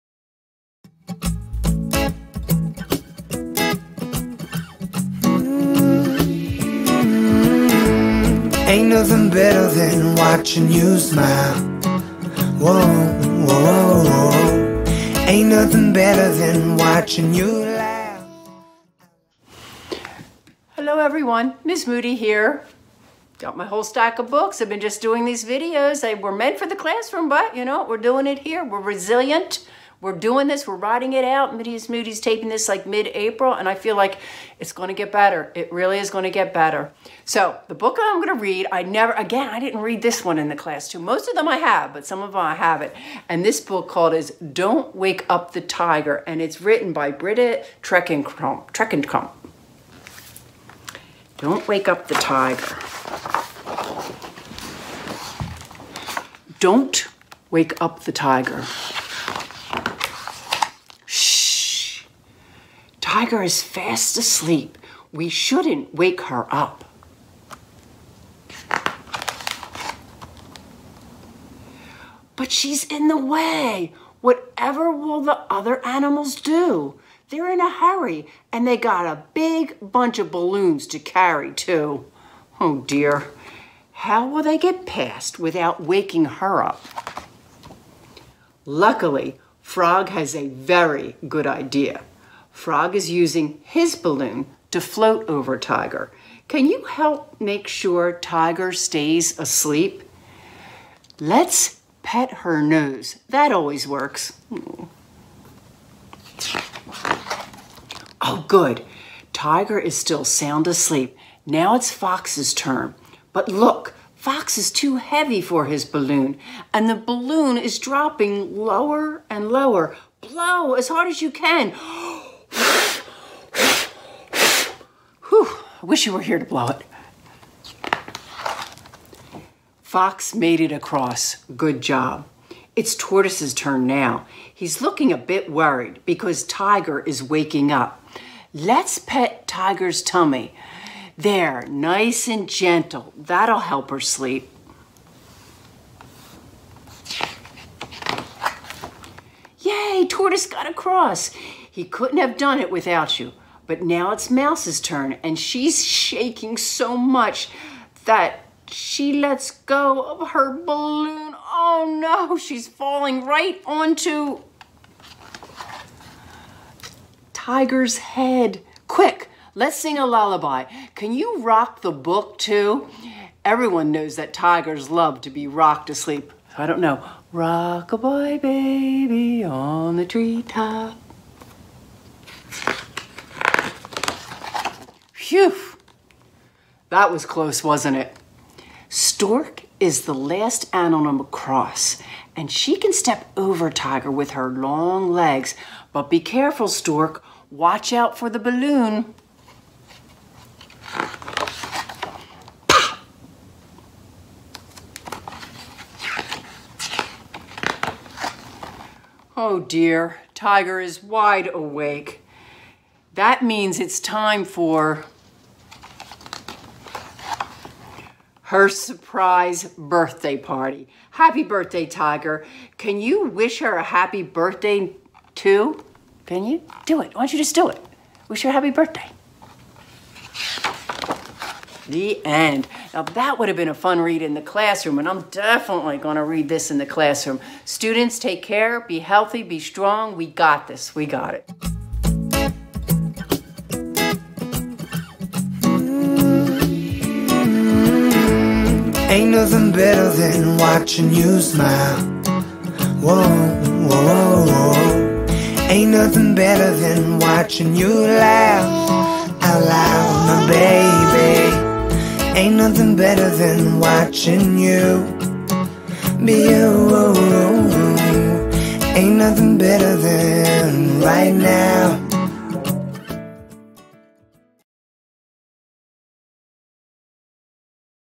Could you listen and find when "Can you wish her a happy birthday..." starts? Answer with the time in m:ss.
3:42.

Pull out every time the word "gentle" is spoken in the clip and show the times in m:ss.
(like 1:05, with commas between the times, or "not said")
2:22.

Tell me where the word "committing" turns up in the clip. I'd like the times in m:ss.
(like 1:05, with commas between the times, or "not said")
not said.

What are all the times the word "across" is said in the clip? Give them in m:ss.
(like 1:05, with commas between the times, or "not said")
2:10, 2:30, 3:11.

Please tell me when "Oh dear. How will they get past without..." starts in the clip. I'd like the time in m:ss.
1:22.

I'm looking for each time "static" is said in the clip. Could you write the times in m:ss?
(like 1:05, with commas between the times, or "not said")
not said.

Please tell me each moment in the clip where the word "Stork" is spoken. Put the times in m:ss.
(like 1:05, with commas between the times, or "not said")
3:08, 3:16.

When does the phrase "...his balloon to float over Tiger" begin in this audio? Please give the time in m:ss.
1:33.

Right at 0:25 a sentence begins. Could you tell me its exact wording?
They were meant for the classroom, but you know, we're doing it here.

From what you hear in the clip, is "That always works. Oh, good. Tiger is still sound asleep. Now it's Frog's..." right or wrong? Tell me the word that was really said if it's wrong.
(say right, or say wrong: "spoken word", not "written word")
wrong: "Fox", not "Frog".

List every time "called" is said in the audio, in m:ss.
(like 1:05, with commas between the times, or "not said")
0:43.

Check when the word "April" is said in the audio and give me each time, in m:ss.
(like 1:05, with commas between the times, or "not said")
0:32.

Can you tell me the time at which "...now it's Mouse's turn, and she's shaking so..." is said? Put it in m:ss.
2:33.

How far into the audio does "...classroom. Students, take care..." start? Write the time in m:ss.
3:56.